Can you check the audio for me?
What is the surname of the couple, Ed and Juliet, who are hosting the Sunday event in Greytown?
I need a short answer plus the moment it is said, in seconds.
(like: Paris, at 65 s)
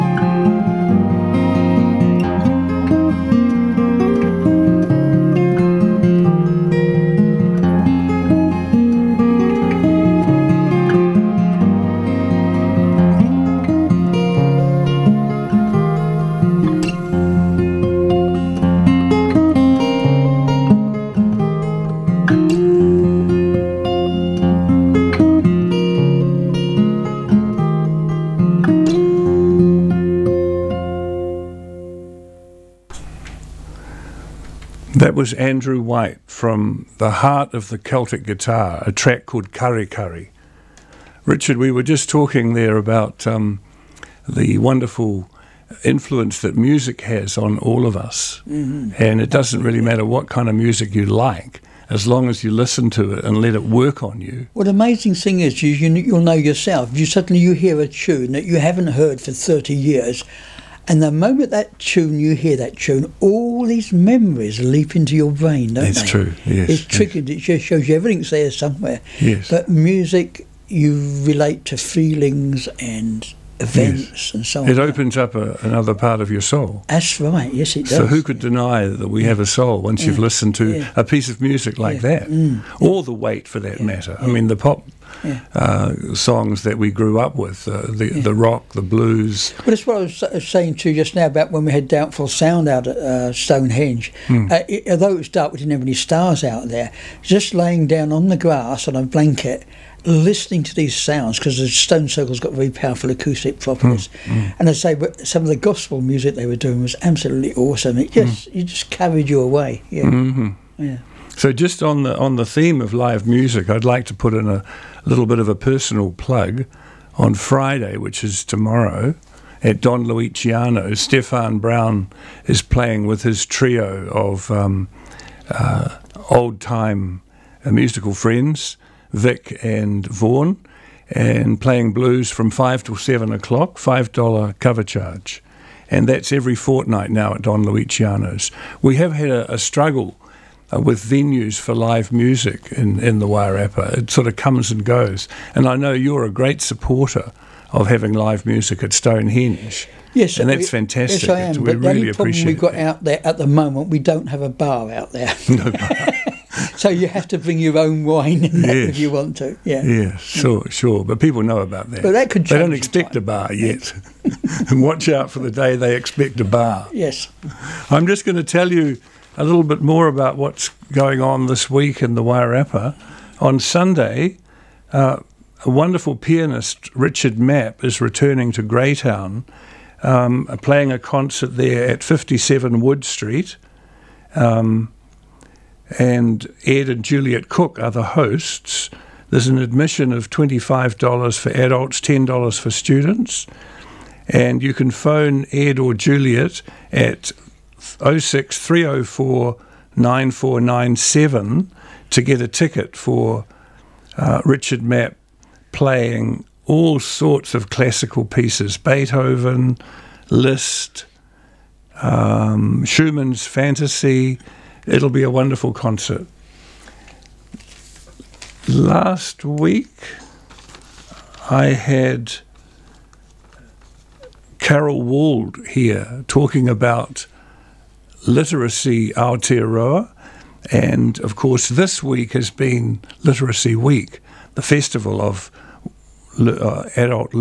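Cook, at 187 s.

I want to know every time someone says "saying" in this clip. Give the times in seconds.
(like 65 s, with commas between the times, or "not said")
90 s.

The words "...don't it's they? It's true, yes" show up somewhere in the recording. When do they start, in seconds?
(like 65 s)
65 s.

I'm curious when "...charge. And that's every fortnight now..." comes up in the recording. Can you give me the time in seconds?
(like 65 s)
134 s.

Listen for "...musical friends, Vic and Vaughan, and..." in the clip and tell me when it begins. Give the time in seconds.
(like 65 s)
127 s.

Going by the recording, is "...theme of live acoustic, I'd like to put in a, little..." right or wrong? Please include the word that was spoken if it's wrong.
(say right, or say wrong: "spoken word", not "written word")
wrong: "music", not "acoustic".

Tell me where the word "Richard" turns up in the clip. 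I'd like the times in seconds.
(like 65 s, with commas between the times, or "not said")
41 s, 176 s, 204 s.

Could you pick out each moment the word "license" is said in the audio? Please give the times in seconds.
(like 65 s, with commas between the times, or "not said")
not said.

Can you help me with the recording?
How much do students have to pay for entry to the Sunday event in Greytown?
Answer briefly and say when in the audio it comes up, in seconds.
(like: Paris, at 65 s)
$10, at 192 s.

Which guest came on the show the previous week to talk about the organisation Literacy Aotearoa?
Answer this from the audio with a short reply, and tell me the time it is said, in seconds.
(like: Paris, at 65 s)
Carol Wald, at 224 s.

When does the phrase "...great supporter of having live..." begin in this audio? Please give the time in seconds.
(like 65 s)
146 s.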